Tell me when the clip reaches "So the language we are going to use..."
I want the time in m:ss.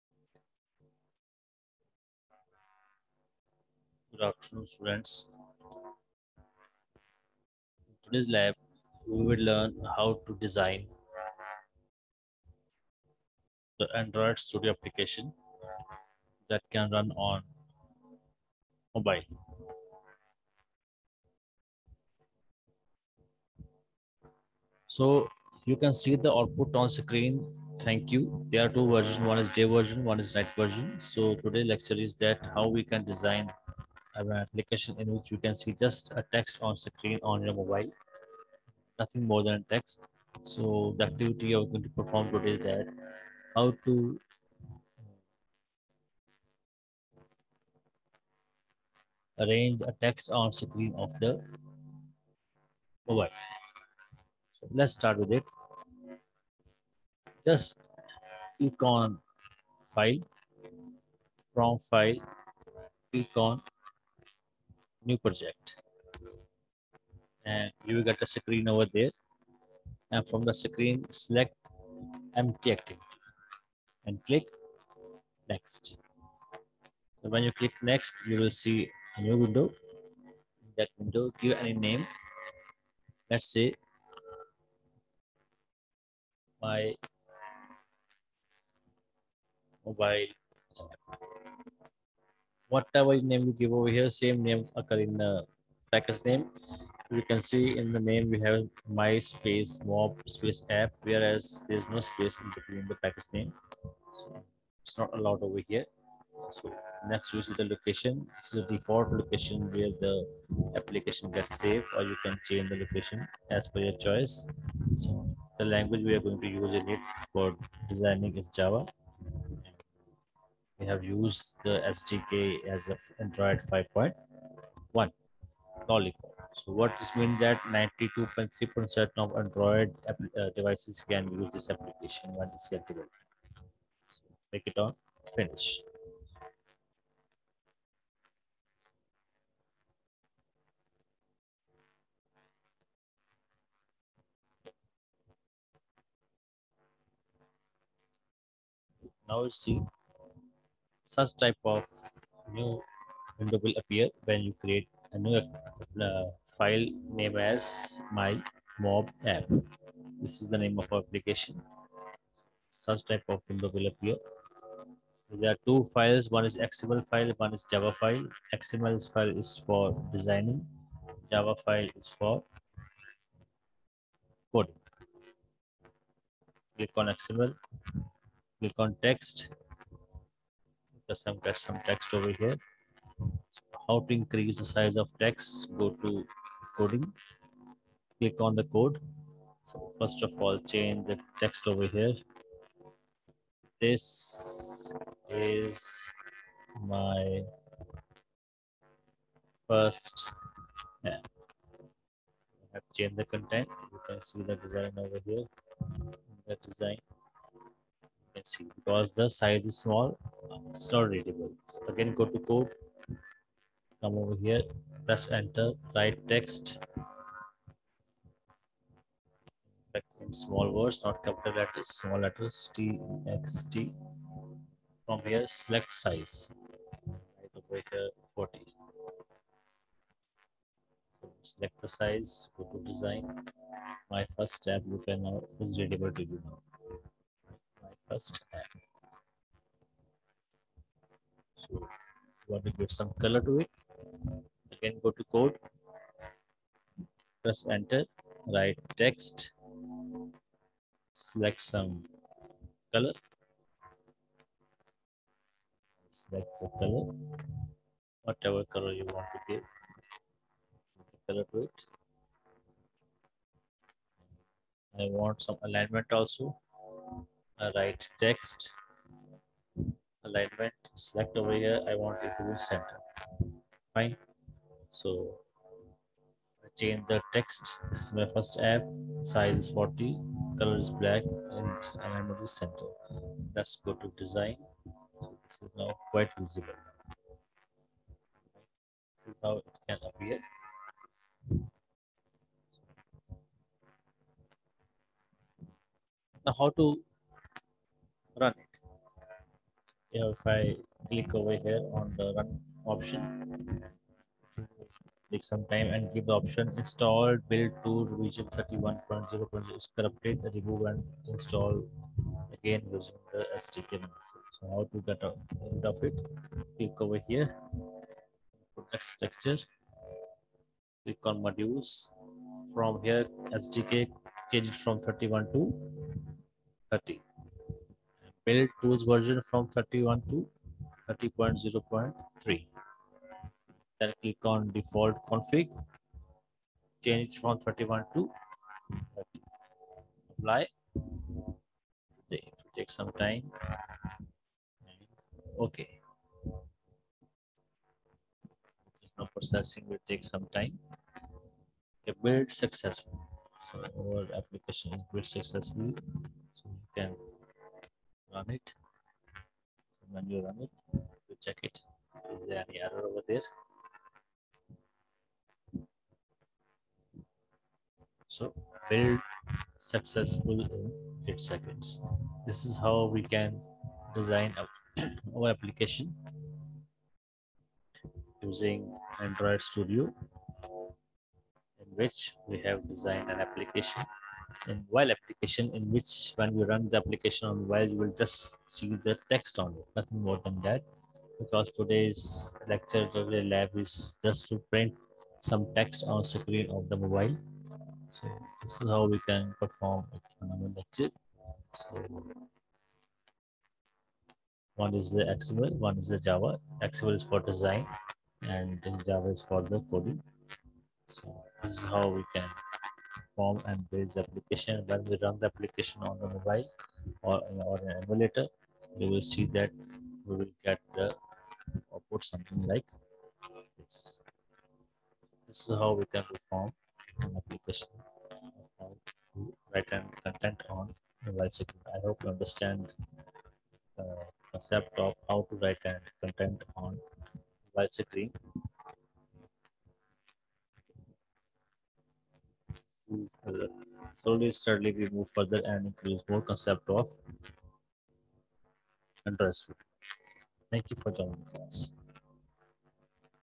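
1:54.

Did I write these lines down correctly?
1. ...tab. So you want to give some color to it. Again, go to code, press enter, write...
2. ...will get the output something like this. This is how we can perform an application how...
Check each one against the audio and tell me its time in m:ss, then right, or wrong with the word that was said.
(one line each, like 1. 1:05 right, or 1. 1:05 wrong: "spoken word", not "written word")
1. 3:58 right
2. 7:00 right.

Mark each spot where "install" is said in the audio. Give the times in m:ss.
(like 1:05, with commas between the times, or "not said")
5:06, 5:11.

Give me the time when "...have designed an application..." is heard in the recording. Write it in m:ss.
6:22.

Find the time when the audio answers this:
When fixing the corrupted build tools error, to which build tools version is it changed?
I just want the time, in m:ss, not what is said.
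5:31.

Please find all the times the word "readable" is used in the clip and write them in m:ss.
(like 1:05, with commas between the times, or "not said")
3:31, 3:55.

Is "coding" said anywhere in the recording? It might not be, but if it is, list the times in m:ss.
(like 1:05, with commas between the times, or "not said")
2:54, 3:06, 6:49.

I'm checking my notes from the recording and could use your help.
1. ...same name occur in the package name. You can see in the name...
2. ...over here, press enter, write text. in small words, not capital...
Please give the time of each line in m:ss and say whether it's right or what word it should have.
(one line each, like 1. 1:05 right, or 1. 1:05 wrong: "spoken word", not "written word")
1. 1:34 right
2. 3:34 right.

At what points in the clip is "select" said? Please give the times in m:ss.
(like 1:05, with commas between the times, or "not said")
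1:11, 3:45, 3:51, 4:11, 4:16, 4:30.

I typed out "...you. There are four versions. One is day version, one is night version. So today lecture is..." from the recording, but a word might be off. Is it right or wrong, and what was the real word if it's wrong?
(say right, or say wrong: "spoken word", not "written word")
wrong: "two", not "four".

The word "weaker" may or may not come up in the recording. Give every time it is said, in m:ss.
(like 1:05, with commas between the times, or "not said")
not said.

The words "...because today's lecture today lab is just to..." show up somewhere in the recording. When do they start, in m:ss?
6:31.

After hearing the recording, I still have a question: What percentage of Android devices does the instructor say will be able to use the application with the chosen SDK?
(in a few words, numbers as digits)
92.3%.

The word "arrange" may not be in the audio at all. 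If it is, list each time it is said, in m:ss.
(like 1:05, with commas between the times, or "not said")
0:49.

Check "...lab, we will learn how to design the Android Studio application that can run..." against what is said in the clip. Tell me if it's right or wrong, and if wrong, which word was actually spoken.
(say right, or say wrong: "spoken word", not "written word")
right.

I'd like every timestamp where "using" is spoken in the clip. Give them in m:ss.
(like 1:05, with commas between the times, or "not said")
5:12, 6:18.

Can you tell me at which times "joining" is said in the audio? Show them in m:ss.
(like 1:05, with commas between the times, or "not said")
7:31.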